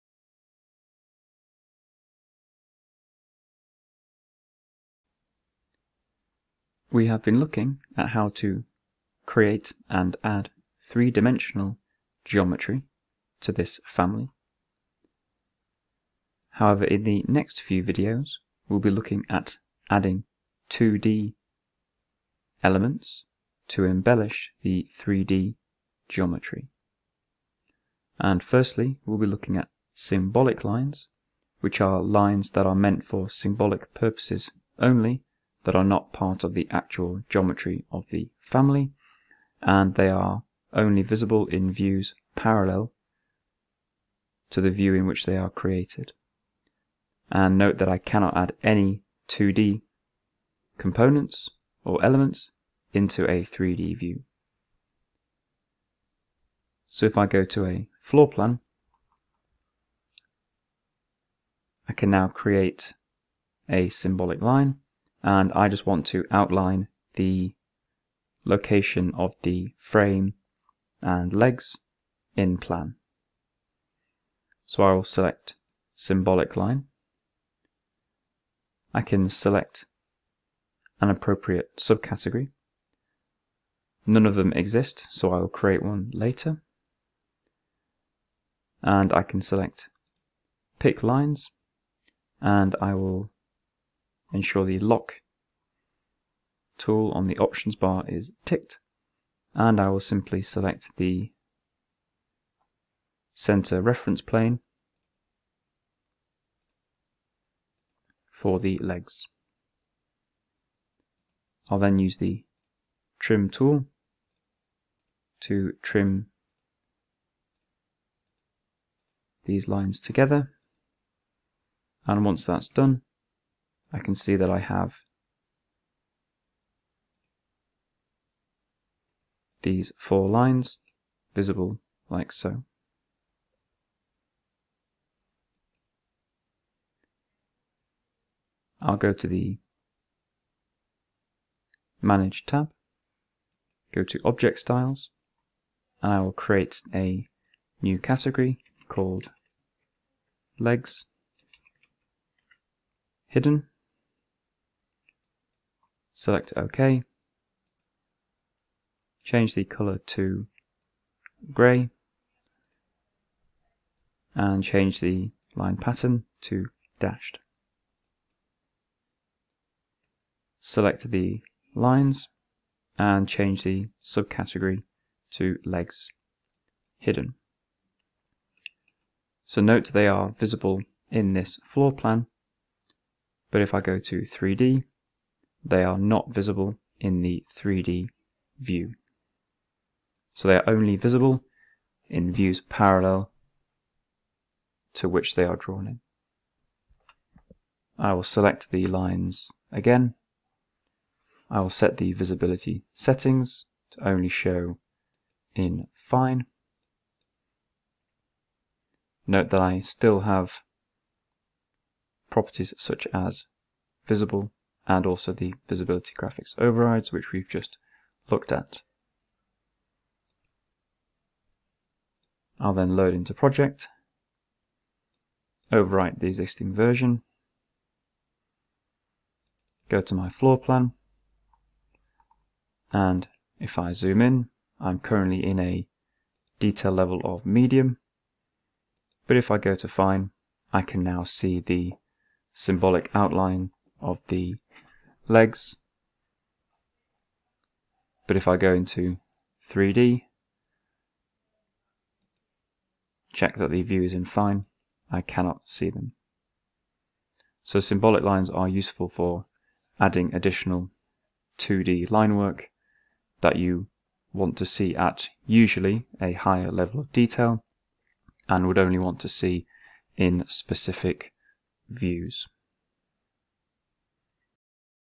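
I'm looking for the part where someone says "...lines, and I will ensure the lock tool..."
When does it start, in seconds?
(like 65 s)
91 s.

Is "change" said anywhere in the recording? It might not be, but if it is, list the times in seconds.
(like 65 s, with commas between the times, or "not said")
159 s, 164 s, 173 s.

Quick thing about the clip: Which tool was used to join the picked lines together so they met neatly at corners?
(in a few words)
Trim tool.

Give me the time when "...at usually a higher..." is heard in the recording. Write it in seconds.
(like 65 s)
264 s.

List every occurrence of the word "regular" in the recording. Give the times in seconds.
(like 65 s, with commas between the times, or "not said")
not said.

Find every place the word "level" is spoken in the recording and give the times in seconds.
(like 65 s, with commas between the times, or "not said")
236 s, 266 s.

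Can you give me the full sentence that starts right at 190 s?
So they are only visible in views parallel to which they are drawn in.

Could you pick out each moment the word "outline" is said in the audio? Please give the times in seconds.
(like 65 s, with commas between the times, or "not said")
66 s, 243 s.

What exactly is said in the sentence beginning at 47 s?
And note that I cannot add any 2D components or elements into a 3D view.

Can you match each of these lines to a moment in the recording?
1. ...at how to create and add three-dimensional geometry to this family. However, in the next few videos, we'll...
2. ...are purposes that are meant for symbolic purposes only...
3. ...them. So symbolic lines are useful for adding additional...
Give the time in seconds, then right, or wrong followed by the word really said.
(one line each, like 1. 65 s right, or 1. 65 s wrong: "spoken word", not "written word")
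1. 7 s right
2. 31 s wrong: "lines", not "purposes"
3. 255 s right.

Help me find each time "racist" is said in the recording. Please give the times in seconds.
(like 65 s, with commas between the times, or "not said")
not said.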